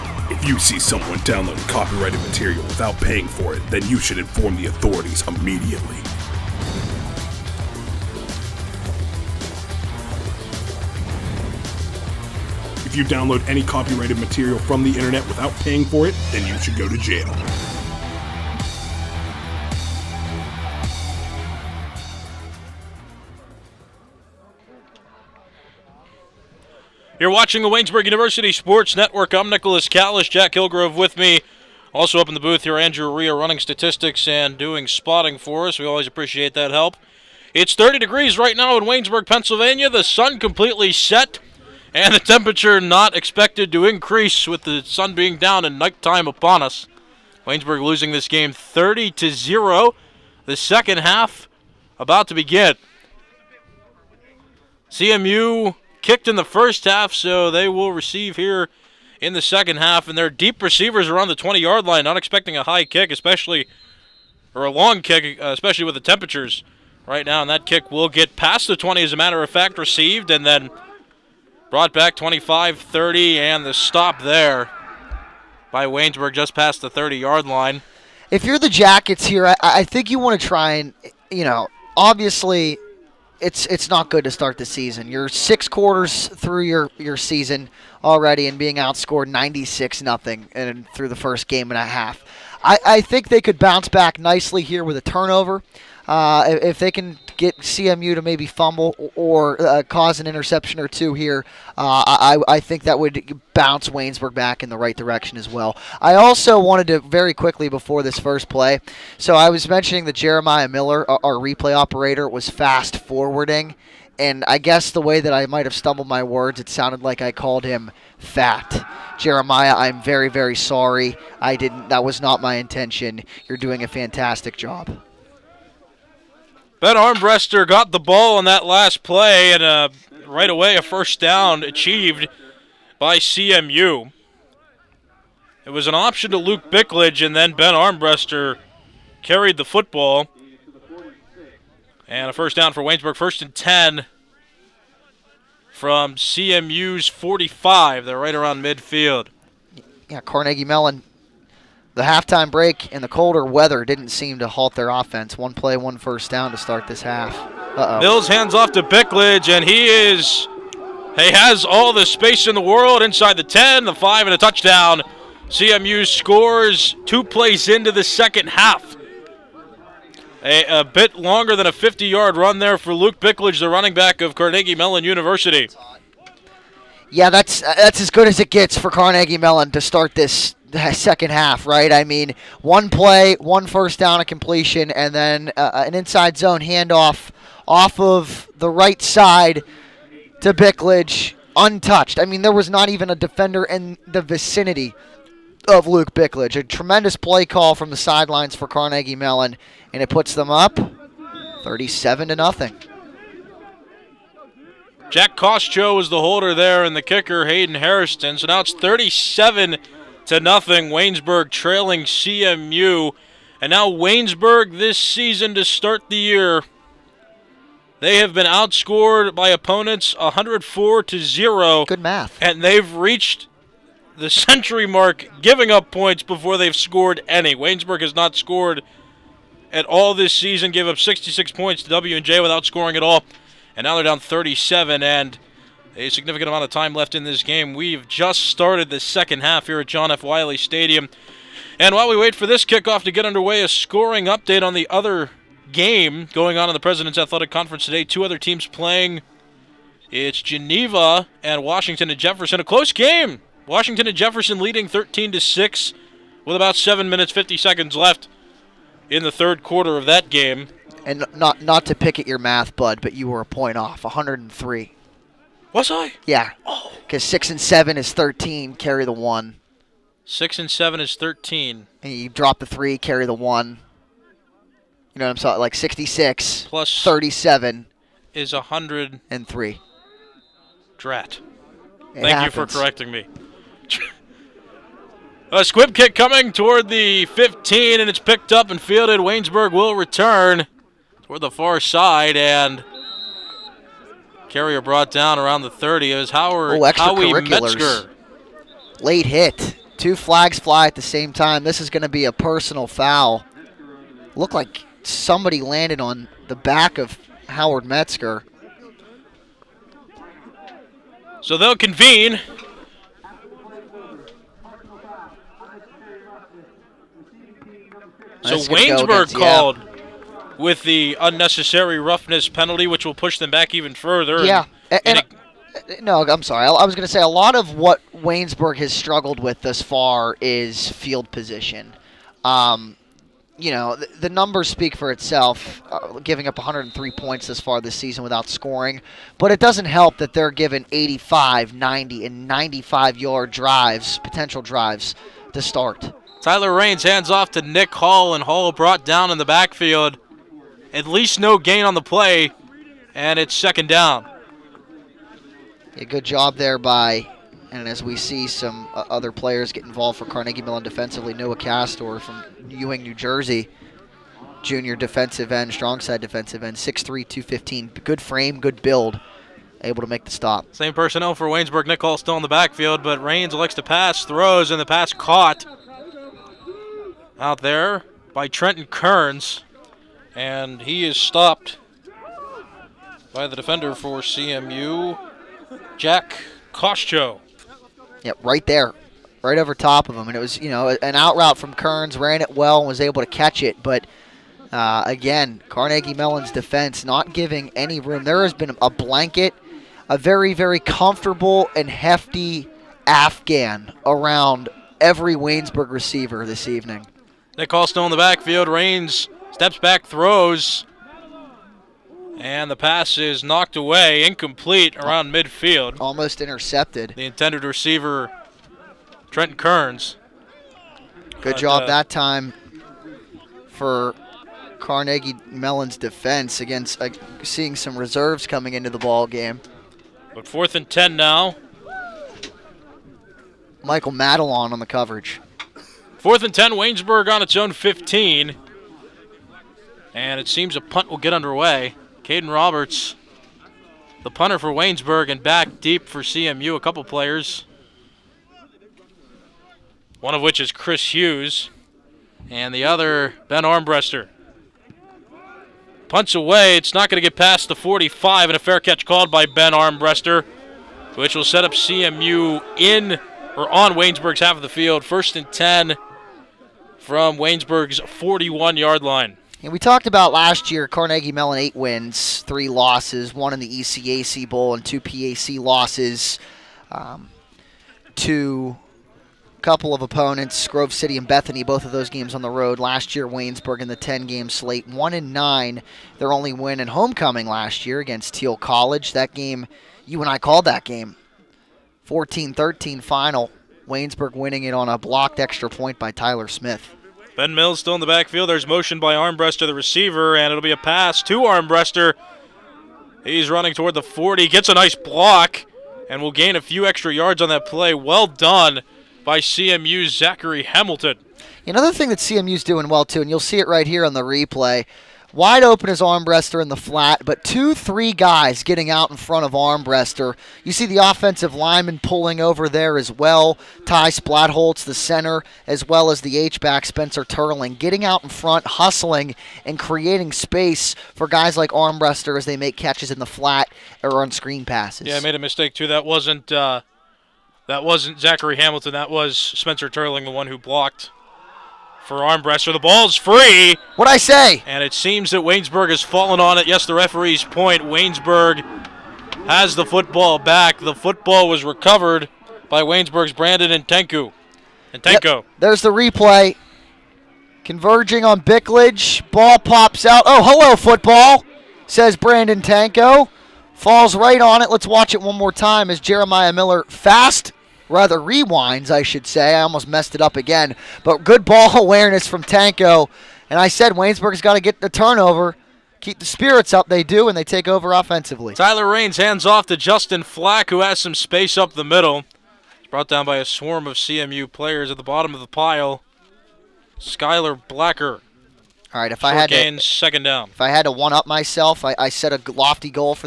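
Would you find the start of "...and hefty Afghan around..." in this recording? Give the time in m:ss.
6:41.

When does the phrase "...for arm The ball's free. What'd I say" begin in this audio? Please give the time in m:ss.
9:02.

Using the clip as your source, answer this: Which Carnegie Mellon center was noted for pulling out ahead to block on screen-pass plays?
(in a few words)
Ty Splatholz.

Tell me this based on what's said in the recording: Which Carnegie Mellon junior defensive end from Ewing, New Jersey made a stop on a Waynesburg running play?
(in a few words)
Noah Castor.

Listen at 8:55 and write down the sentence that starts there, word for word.
Yeah, I made a mistake too.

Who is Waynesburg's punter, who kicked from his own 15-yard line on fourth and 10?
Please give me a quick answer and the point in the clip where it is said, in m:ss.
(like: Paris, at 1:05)
Caden Roberts, at 7:22.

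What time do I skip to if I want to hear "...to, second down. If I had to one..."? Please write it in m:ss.
9:49.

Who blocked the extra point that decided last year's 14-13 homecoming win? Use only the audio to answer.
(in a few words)
Tyler Smith.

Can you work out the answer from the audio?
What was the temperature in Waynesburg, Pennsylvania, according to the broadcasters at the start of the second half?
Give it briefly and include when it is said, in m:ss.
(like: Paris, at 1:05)
30 degrees, at 0:37.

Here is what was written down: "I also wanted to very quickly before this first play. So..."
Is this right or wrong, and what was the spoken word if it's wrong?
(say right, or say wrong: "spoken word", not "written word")
right.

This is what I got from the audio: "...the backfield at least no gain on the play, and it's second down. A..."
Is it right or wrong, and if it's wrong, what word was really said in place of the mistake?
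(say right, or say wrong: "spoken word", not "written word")
right.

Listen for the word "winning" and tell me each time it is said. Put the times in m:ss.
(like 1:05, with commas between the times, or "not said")
8:14.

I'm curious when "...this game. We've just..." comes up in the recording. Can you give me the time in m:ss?
3:57.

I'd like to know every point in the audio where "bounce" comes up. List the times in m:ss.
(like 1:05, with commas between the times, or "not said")
1:33, 1:43.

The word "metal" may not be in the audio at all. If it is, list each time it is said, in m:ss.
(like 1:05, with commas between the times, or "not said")
not said.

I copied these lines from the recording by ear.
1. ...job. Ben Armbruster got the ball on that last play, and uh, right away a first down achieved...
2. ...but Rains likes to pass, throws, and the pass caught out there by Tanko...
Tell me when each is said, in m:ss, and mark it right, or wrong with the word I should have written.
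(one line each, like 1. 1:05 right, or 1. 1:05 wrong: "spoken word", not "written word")
1. 2:04 right
2. 6:13 wrong: "Trenton", not "Tanko".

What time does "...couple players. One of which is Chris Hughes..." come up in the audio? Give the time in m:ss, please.
7:26.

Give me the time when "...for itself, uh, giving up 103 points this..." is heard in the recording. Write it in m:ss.
5:34.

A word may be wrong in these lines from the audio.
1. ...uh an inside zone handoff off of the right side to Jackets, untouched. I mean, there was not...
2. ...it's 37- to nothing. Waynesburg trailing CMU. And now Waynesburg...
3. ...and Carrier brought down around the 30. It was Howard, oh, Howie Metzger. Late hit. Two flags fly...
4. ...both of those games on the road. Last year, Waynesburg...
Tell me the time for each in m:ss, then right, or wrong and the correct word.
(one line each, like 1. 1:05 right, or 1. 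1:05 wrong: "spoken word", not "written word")
1. 3:05 wrong: "Bickledge", not "Jackets"
2. 3:28 right
3. 4:52 right
4. 8:01 right.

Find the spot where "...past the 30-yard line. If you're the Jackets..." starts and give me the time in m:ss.
1:16.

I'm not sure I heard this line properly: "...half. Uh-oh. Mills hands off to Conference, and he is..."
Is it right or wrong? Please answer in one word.
wrong.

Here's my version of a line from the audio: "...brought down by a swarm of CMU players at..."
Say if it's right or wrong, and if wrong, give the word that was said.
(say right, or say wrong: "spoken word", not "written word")
right.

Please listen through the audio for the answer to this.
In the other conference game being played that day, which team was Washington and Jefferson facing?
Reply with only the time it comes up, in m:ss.
4:10.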